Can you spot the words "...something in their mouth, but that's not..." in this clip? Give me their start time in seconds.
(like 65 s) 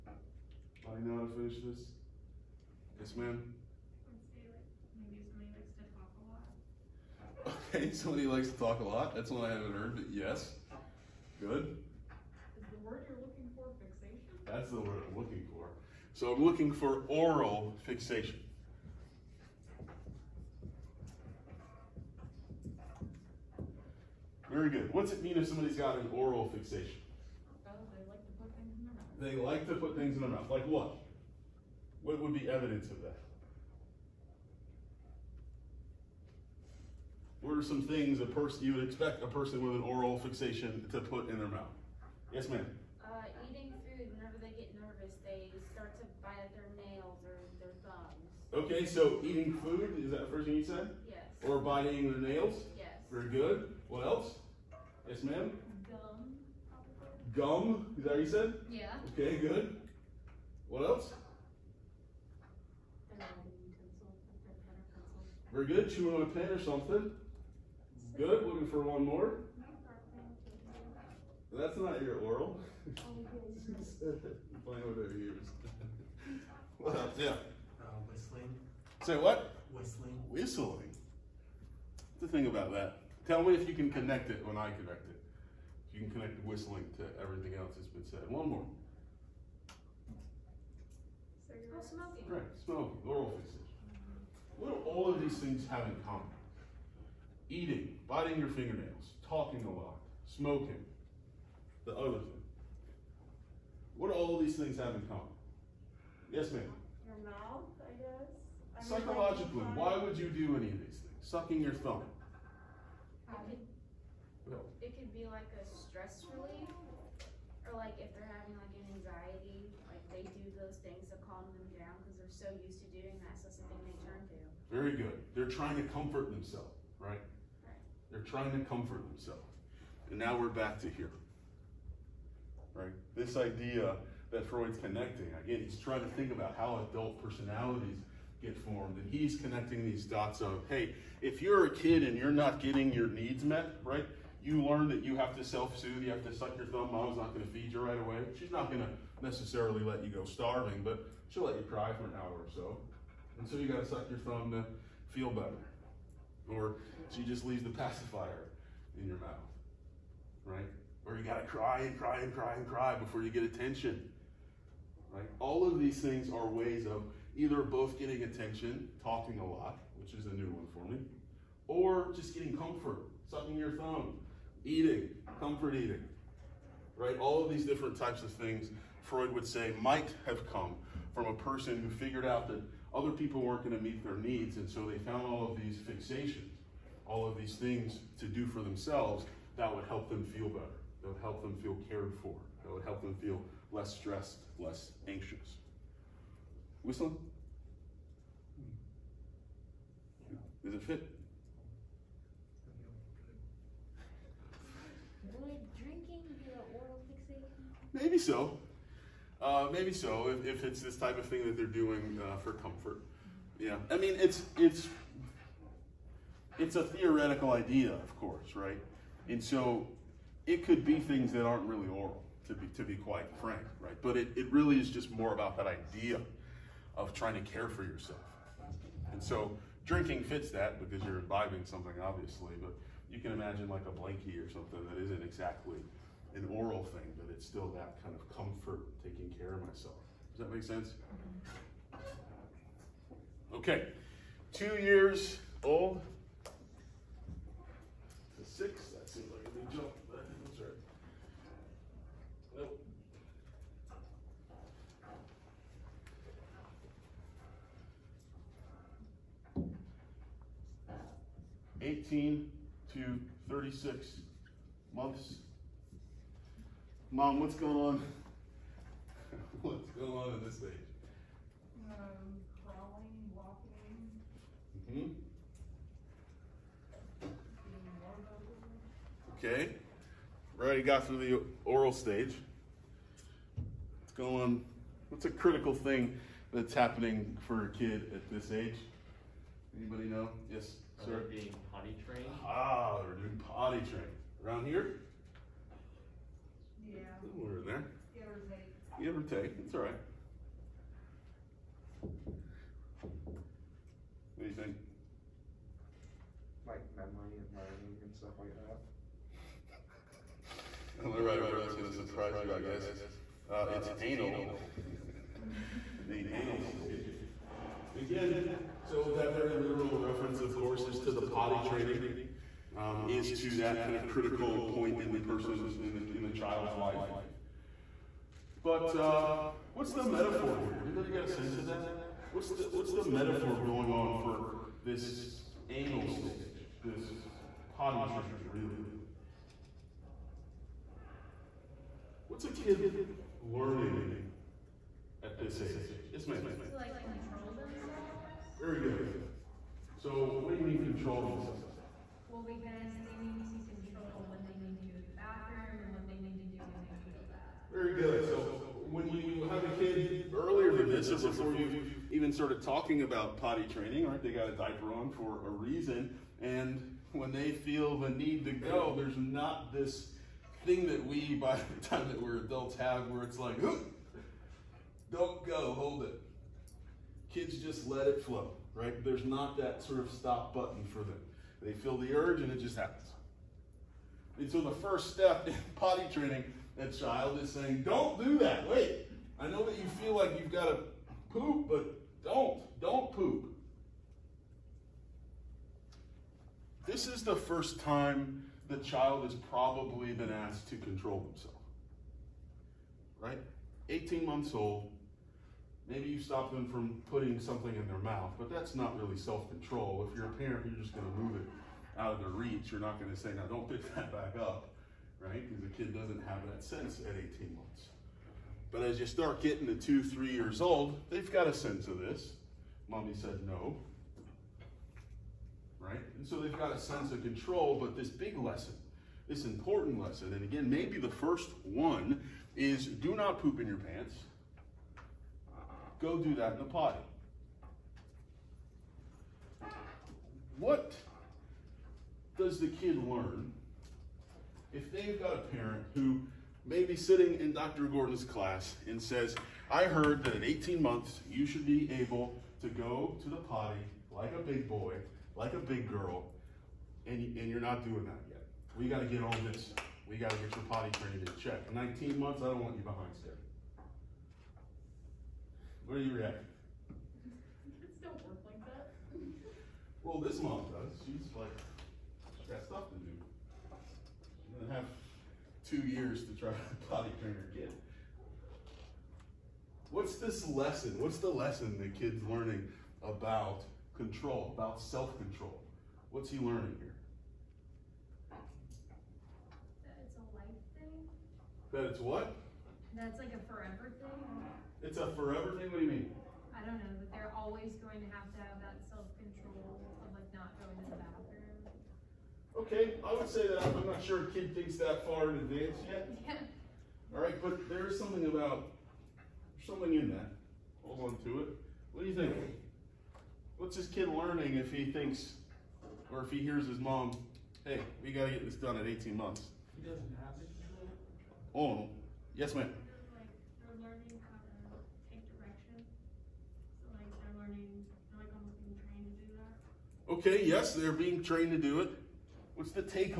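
407 s.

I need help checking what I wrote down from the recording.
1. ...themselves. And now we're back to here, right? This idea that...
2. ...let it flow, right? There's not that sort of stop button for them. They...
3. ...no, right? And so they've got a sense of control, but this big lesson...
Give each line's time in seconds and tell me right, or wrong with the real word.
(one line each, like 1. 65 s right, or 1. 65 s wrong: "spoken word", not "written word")
1. 129 s right
2. 377 s right
3. 423 s right.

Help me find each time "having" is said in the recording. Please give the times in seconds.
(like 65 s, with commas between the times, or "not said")
118 s.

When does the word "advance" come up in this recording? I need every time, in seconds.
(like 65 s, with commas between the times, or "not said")
505 s.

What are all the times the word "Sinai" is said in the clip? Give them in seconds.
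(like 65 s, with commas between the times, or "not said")
not said.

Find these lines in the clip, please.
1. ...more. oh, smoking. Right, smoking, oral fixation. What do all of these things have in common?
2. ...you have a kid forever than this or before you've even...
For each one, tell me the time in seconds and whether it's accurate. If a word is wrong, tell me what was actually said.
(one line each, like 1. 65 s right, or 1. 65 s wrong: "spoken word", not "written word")
1. 88 s right
2. 359 s wrong: "earlier", not "forever".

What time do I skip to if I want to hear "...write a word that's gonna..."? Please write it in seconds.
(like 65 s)
311 s.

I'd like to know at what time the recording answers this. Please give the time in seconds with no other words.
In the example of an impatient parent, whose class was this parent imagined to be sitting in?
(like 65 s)
447 s.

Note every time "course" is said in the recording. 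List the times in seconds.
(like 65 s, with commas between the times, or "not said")
218 s, 320 s.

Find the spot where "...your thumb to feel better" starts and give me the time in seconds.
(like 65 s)
154 s.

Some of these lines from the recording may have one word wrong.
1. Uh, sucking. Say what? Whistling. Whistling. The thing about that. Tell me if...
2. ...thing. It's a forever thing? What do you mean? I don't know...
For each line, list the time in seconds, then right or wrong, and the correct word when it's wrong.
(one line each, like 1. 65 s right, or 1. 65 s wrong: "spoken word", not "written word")
1. 77 s wrong: "whistling", not "sucking"
2. 494 s right.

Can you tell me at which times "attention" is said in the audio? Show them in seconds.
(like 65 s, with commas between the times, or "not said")
163 s, 168 s.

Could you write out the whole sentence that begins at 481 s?
What's the lesson the kid's learning about control, about self control?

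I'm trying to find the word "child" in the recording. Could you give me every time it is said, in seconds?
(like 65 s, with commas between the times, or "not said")
326 s, 386 s, 398 s.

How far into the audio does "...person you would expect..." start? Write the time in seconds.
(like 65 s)
38 s.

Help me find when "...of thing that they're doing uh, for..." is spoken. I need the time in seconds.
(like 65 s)
211 s.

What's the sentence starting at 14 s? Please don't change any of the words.
That's the word I'm looking for.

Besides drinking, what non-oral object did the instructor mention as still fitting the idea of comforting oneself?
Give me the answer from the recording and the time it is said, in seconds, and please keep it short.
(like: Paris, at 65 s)
A blankie, at 233 s.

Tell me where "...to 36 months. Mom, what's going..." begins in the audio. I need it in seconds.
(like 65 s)
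262 s.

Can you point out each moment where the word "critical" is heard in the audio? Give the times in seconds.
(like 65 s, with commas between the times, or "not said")
285 s, 324 s.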